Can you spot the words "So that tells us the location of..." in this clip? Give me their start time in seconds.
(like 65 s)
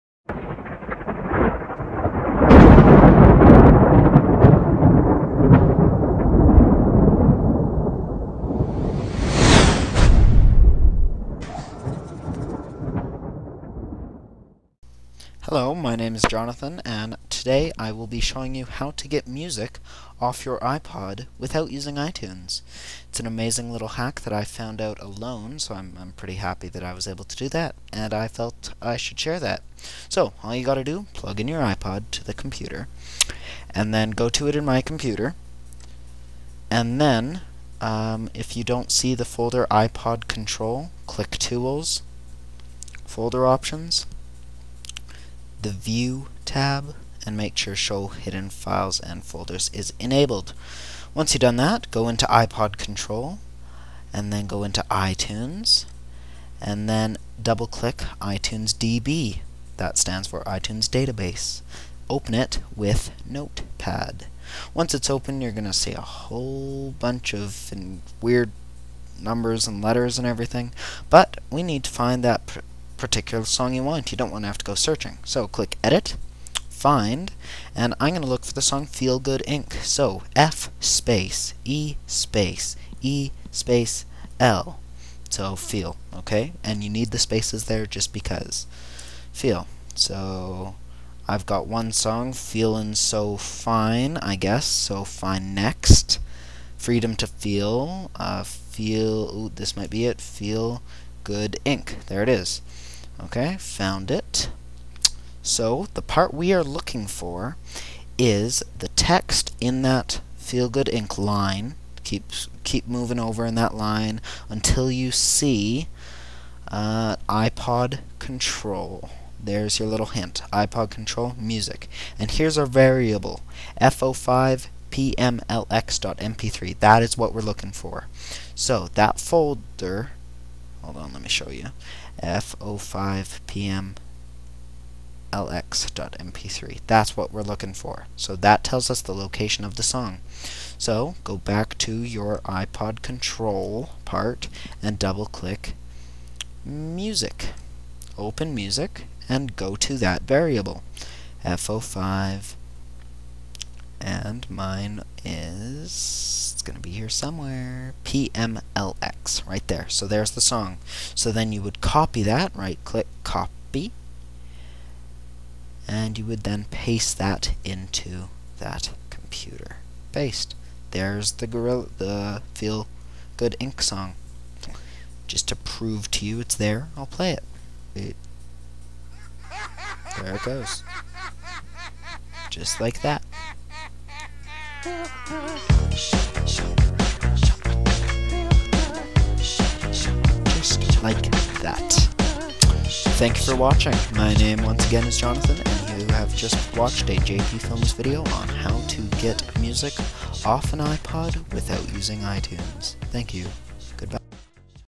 138 s.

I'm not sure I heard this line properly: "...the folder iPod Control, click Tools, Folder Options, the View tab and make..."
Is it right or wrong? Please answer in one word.
right.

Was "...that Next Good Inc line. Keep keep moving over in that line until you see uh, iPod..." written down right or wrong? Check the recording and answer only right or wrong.
wrong.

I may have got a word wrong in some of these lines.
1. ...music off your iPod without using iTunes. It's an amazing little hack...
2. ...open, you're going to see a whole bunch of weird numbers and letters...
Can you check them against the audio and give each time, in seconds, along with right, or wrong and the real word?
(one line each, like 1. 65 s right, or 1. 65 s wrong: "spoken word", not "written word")
1. 19 s right
2. 65 s right.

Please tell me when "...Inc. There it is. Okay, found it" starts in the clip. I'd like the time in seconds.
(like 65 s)
101 s.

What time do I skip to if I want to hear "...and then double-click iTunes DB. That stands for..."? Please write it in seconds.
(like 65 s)
56 s.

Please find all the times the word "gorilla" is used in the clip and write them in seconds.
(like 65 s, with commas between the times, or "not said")
171 s.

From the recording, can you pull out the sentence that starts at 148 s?
Open music and go to that variable.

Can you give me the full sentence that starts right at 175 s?
Just to prove to you it's there, I'll play it.